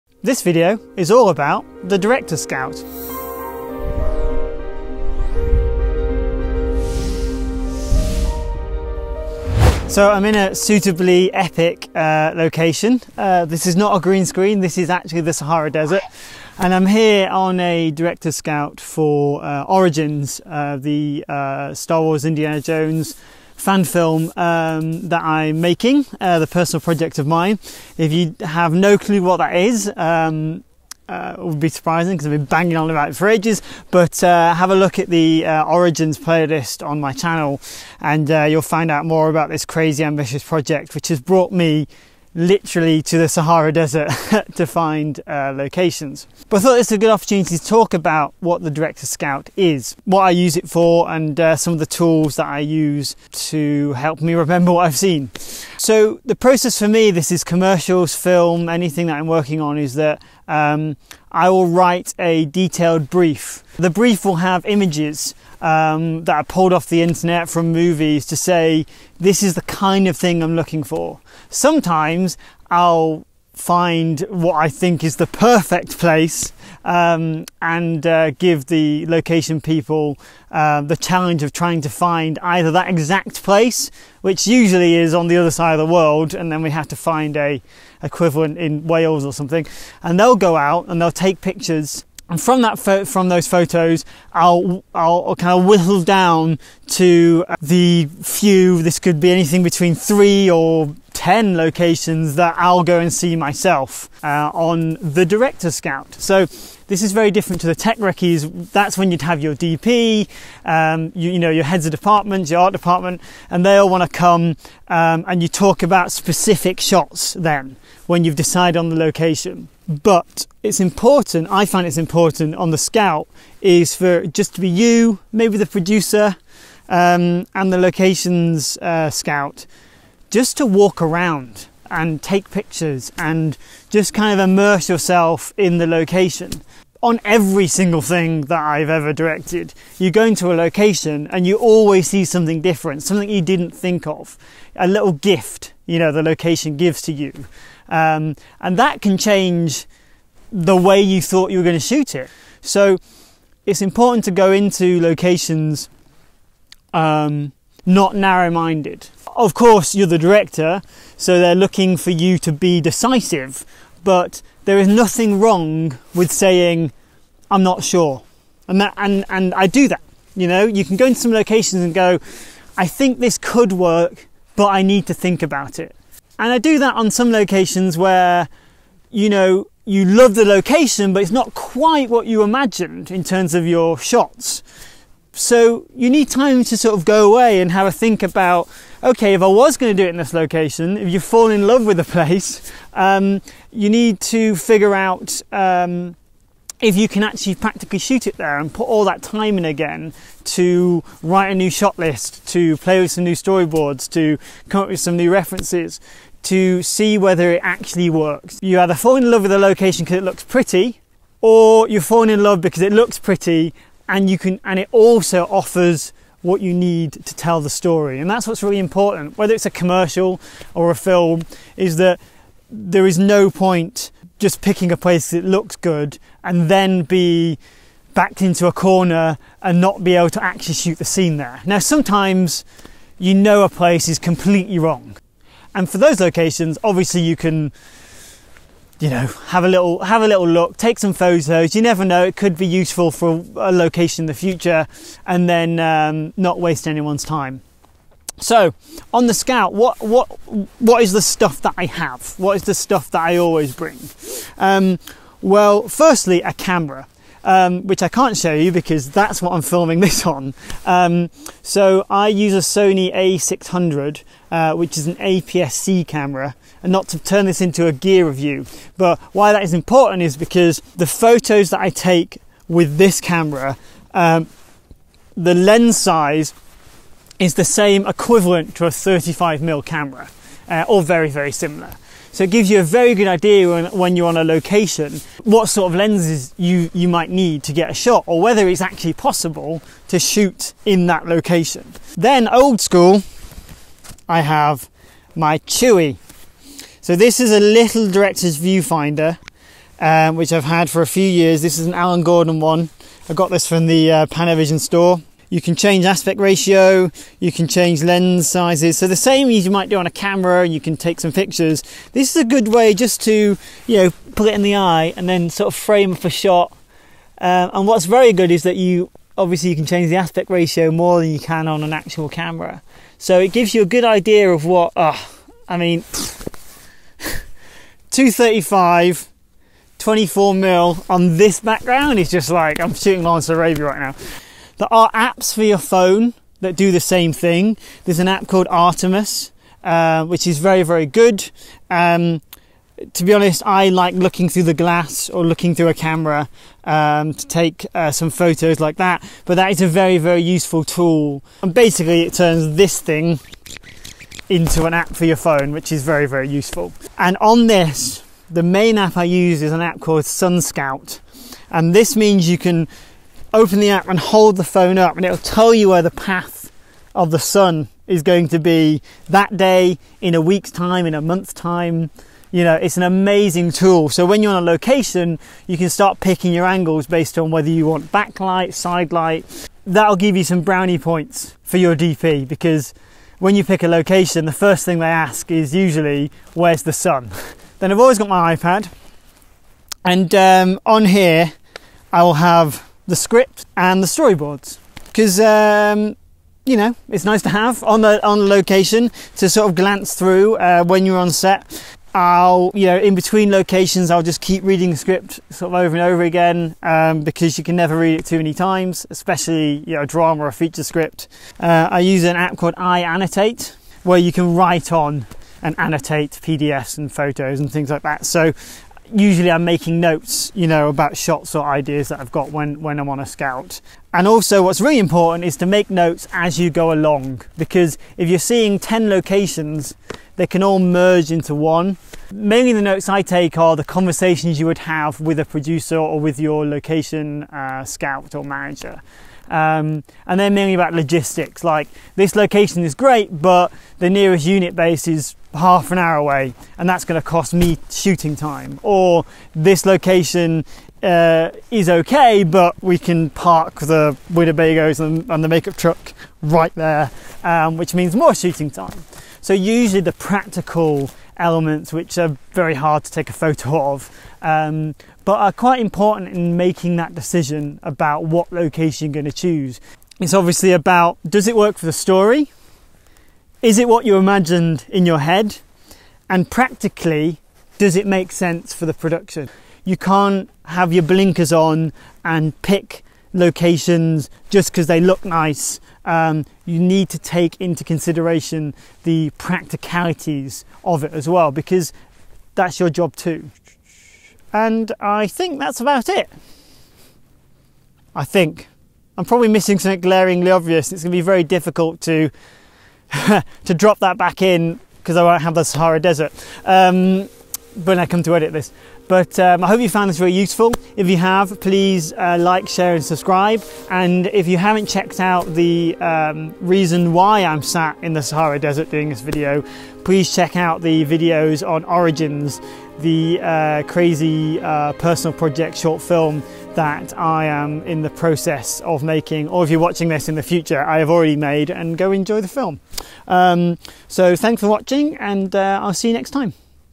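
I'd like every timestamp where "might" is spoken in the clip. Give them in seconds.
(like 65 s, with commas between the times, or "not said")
287 s, 309 s.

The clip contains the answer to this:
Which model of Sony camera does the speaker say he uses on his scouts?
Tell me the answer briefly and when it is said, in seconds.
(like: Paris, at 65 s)
Sony A600, at 262 s.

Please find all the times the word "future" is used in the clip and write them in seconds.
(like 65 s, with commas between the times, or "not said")
244 s, 530 s.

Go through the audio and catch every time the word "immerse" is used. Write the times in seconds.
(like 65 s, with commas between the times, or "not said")
134 s.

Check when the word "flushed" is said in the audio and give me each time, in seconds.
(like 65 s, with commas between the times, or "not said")
not said.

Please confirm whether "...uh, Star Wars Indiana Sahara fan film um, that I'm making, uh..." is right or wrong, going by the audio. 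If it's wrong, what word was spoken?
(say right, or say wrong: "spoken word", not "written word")
wrong: "Jones", not "Sahara".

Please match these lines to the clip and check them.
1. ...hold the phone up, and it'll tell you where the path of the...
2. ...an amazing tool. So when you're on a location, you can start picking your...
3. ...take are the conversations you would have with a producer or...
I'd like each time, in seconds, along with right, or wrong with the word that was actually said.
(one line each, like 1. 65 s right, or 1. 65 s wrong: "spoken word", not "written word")
1. 364 s right
2. 372 s right
3. 433 s right.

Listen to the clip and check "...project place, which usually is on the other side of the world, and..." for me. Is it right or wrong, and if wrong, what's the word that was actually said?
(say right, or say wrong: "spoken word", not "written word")
wrong: "exact", not "project".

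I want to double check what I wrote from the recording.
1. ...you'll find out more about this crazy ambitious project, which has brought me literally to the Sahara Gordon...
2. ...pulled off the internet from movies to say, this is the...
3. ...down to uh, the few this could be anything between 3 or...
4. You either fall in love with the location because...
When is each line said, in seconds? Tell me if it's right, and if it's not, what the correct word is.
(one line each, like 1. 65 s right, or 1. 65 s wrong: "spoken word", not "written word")
1. 38 s wrong: "Desert", not "Gordon"
2. 66 s right
3. 96 s right
4. 208 s right.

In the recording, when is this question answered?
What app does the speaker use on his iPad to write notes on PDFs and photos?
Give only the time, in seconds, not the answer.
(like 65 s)
412 s.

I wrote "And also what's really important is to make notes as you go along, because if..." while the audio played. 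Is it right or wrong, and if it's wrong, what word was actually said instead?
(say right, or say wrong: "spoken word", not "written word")
right.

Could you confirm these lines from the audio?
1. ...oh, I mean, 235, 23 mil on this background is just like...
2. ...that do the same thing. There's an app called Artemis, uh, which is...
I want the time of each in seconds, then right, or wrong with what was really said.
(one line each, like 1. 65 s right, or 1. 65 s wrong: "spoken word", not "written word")
1. 324 s wrong: "24", not "23"
2. 336 s right.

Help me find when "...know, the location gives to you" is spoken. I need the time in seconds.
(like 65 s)
145 s.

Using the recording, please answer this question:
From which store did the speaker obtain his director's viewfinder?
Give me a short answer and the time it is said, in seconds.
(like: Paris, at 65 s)
Panavision, at 304 s.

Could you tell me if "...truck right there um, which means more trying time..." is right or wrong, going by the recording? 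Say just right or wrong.
wrong.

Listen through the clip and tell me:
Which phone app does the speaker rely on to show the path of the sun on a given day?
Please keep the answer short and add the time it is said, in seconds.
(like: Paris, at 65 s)
Sun Scout, at 360 s.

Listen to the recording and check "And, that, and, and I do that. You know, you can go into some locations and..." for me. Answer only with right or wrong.
right.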